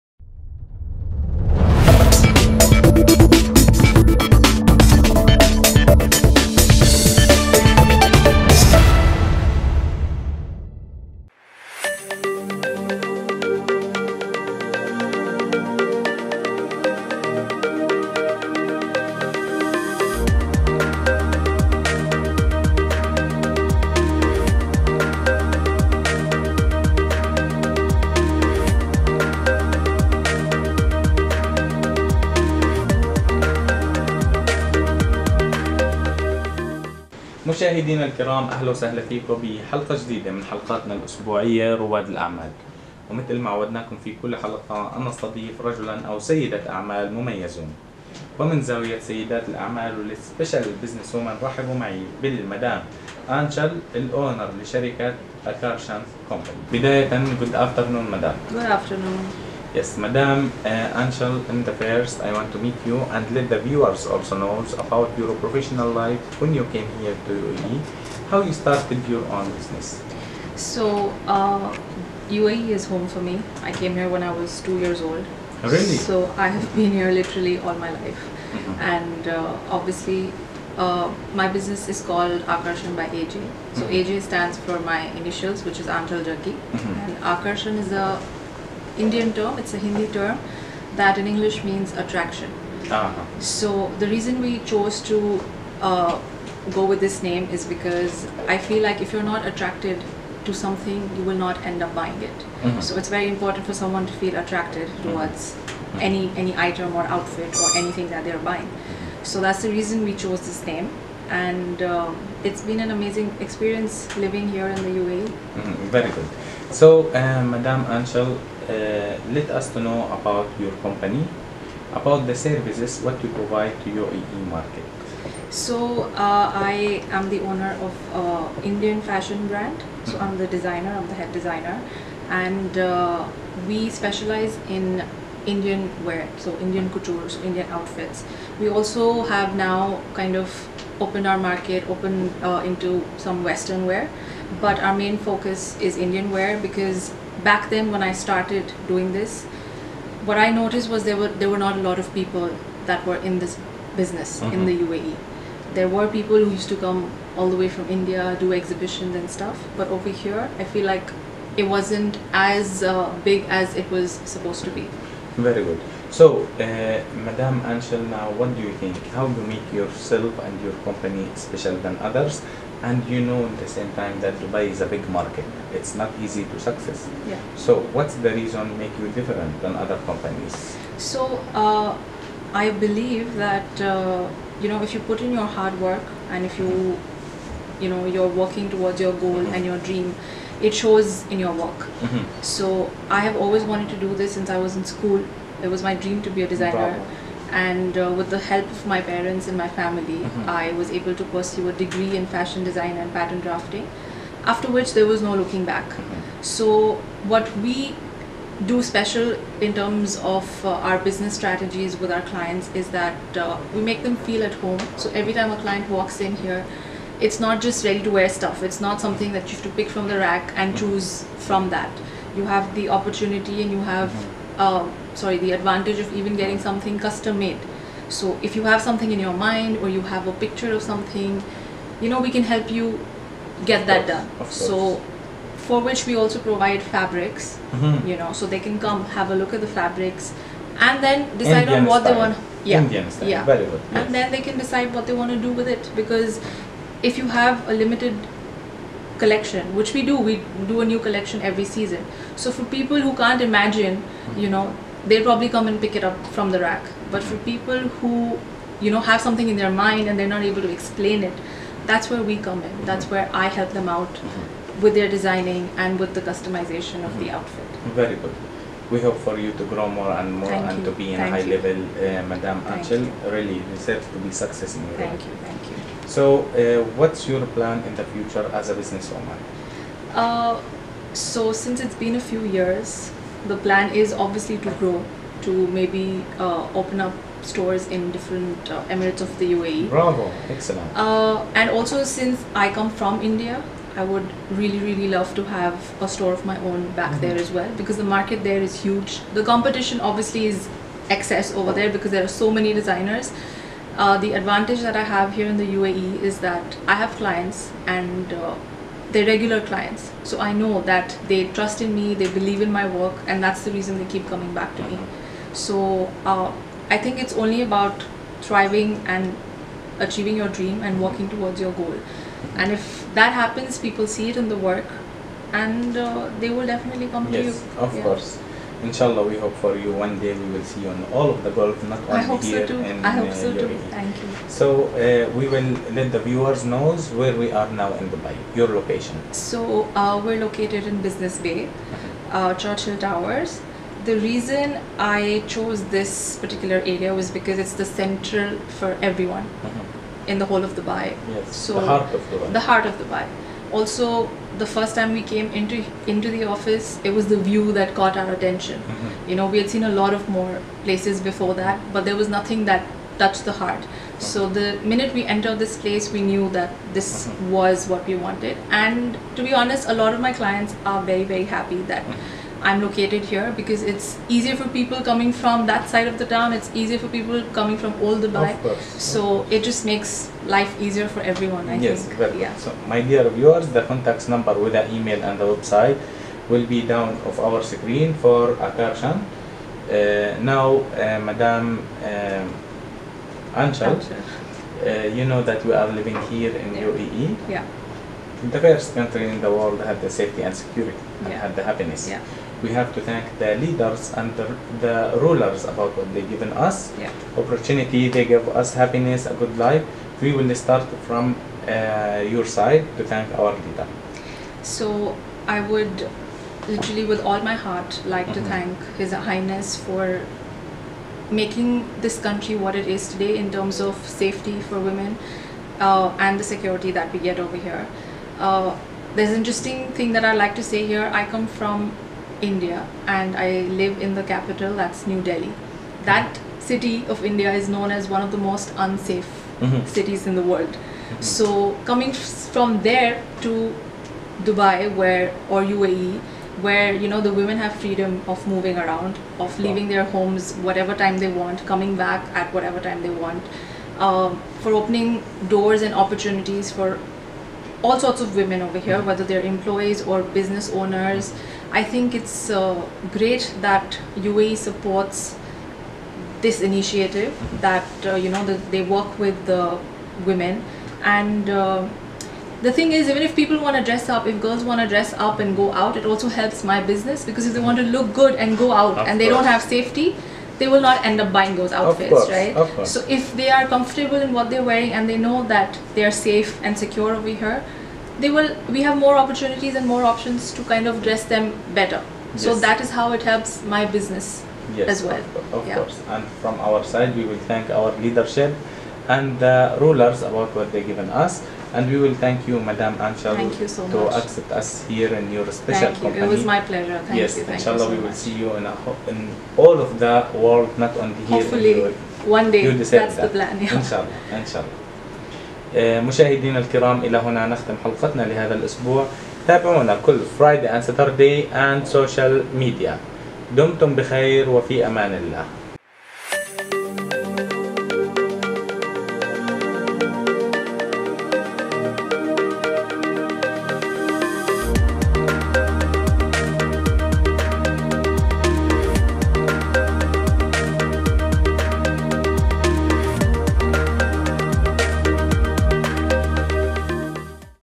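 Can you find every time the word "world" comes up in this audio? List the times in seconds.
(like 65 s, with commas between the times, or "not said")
399 s, 440 s, 510 s.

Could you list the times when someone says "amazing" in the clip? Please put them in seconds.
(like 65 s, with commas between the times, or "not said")
112 s.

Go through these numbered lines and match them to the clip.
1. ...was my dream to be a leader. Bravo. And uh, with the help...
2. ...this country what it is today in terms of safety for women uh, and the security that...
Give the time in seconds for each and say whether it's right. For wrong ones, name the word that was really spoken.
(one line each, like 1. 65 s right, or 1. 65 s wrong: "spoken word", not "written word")
1. 195 s wrong: "designer", not "leader"
2. 422 s right.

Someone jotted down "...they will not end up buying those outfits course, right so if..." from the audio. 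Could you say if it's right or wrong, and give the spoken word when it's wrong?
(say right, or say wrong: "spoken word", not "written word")
right.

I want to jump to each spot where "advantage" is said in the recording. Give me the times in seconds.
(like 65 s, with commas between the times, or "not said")
225 s, 304 s.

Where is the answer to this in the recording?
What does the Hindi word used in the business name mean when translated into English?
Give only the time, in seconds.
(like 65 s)
91 s.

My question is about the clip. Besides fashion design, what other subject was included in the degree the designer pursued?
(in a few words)
pattern drafting.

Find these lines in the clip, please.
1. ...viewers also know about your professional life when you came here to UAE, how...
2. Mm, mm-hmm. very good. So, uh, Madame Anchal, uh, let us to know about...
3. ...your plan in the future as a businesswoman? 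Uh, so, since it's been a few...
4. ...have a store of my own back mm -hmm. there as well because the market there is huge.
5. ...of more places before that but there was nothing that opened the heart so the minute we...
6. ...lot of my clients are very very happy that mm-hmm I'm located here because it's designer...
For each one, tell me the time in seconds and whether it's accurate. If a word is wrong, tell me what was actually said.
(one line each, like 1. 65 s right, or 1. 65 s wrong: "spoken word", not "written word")
1. 63 s right
2. 115 s right
3. 277 s right
4. 295 s right
5. 360 s wrong: "touched", not "opened"
6. 369 s wrong: "easier", not "designer".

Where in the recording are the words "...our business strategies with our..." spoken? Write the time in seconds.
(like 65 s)
210 s.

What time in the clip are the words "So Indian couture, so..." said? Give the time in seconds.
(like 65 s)
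136 s.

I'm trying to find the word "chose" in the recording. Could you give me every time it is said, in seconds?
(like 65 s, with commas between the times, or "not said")
94 s, 110 s, 345 s.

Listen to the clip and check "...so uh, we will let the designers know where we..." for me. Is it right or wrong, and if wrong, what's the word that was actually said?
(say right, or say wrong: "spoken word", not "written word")
wrong: "viewers", not "designers".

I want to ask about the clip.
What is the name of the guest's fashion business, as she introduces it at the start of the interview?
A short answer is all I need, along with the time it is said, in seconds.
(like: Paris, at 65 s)
Akarshan by AJ, at 82 s.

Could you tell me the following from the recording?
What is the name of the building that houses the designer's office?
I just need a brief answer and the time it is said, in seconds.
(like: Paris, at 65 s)
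Churchill Towers, at 342 s.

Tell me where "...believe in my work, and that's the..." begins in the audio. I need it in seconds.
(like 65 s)
312 s.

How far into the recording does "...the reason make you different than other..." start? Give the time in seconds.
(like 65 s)
178 s.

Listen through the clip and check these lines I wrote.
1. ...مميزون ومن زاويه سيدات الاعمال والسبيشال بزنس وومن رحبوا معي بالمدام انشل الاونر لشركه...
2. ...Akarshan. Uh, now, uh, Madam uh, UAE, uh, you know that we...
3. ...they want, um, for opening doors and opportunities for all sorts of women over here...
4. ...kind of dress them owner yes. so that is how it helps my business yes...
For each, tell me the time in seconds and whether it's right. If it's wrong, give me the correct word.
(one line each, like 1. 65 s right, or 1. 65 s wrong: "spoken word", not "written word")
1. 47 s right
2. 388 s wrong: "Anchal", not "UAE"
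3. 453 s right
4. 490 s wrong: "better", not "owner".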